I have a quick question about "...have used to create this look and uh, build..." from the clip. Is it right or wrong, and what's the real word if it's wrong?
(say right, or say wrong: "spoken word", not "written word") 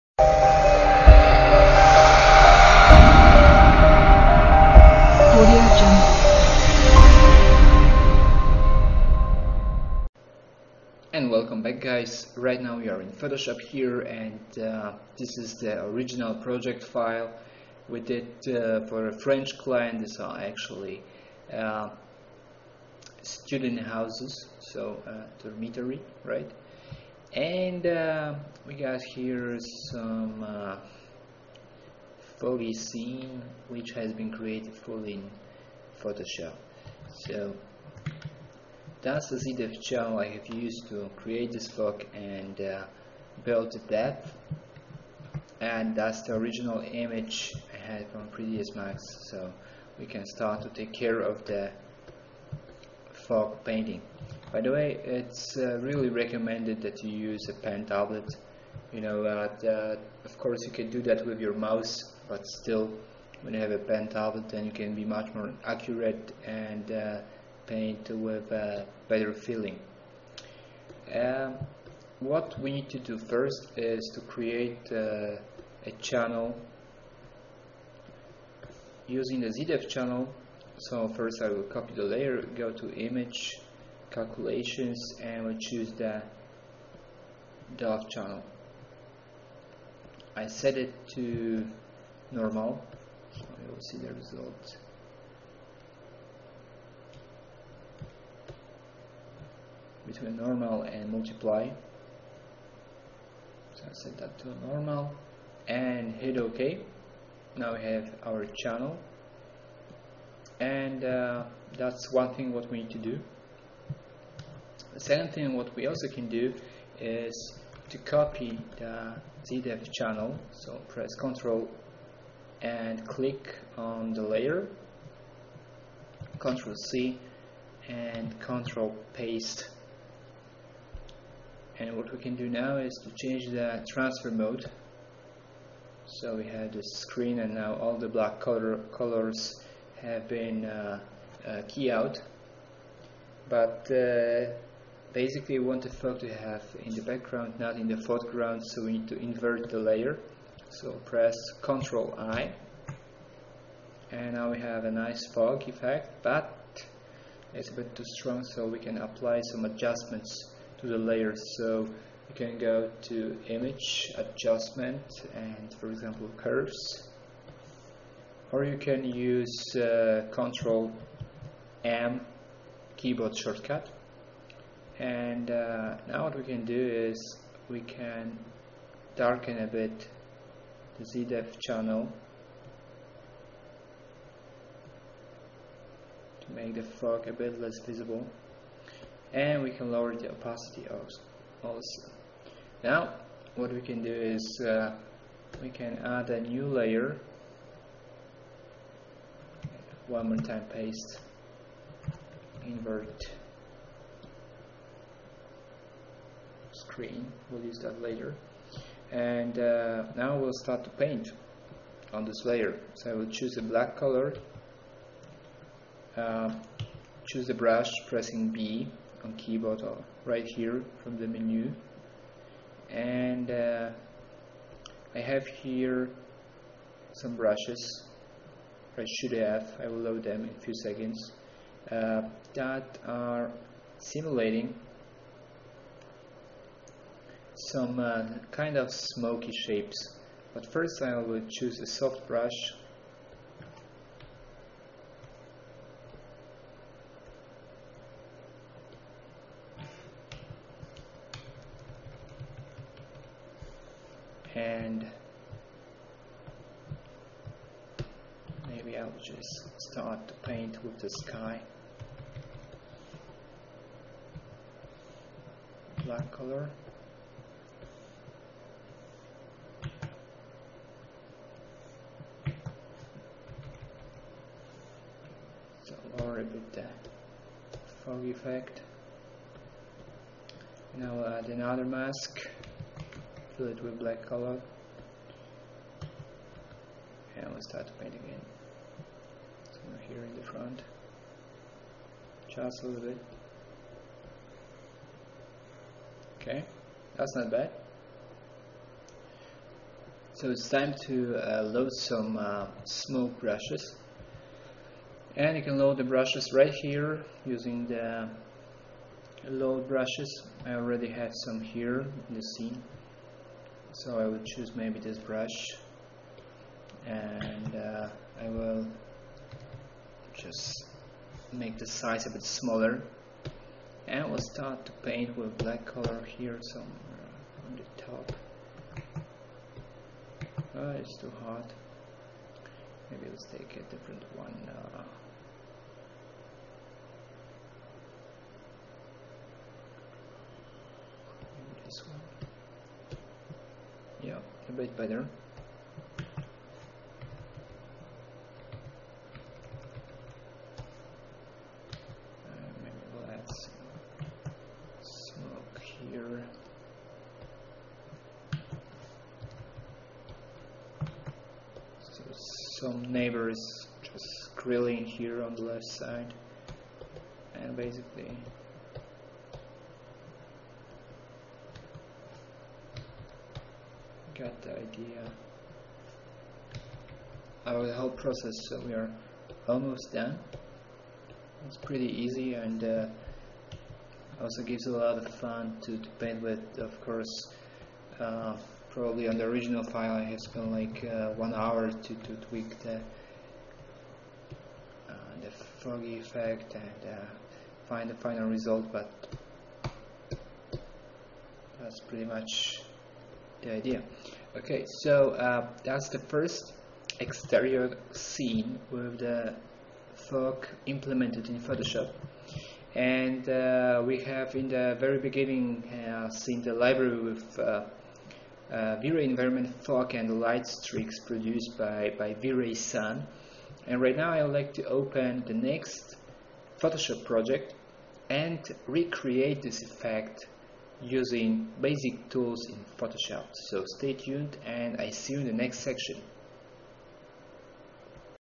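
right.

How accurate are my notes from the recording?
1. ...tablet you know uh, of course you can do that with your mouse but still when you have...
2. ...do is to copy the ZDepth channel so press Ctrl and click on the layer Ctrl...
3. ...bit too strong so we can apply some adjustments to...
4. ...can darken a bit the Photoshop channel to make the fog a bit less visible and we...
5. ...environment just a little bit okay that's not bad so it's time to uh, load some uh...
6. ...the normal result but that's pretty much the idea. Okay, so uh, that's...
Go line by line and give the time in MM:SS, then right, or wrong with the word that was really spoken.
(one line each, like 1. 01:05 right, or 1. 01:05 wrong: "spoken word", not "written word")
1. 00:57 right
2. 01:56 right
3. 02:37 right
4. 02:57 wrong: "ZDepth", not "Photoshop"
5. 04:50 wrong: "front", not "environment"
6. 06:38 wrong: "final", not "normal".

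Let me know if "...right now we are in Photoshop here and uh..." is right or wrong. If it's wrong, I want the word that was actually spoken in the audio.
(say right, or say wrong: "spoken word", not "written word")
right.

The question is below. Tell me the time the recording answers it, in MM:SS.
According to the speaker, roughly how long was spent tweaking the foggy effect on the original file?
06:31.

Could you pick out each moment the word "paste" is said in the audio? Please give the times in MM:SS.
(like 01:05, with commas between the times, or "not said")
02:09, 03:20.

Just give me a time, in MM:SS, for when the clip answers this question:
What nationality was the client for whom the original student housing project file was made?
00:19.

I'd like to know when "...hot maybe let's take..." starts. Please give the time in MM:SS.
05:31.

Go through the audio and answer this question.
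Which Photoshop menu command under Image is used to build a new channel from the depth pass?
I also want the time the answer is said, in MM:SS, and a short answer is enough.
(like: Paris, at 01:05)
Calculations, at 01:24.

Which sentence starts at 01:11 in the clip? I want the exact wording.
Um, what we need to do first is to create uh, a channel using the ZDepth channel.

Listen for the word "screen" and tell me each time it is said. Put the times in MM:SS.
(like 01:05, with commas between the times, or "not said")
02:16, 03:26.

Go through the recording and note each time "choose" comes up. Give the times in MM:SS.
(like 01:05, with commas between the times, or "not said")
01:25, 03:33, 03:37, 04:01, 05:14.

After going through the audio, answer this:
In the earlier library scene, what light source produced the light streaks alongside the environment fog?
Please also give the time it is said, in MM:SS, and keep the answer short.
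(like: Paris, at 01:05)
V-Ray Sun, at 07:02.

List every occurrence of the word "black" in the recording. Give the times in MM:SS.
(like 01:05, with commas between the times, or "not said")
02:18, 03:33, 04:26, 04:43, 05:25.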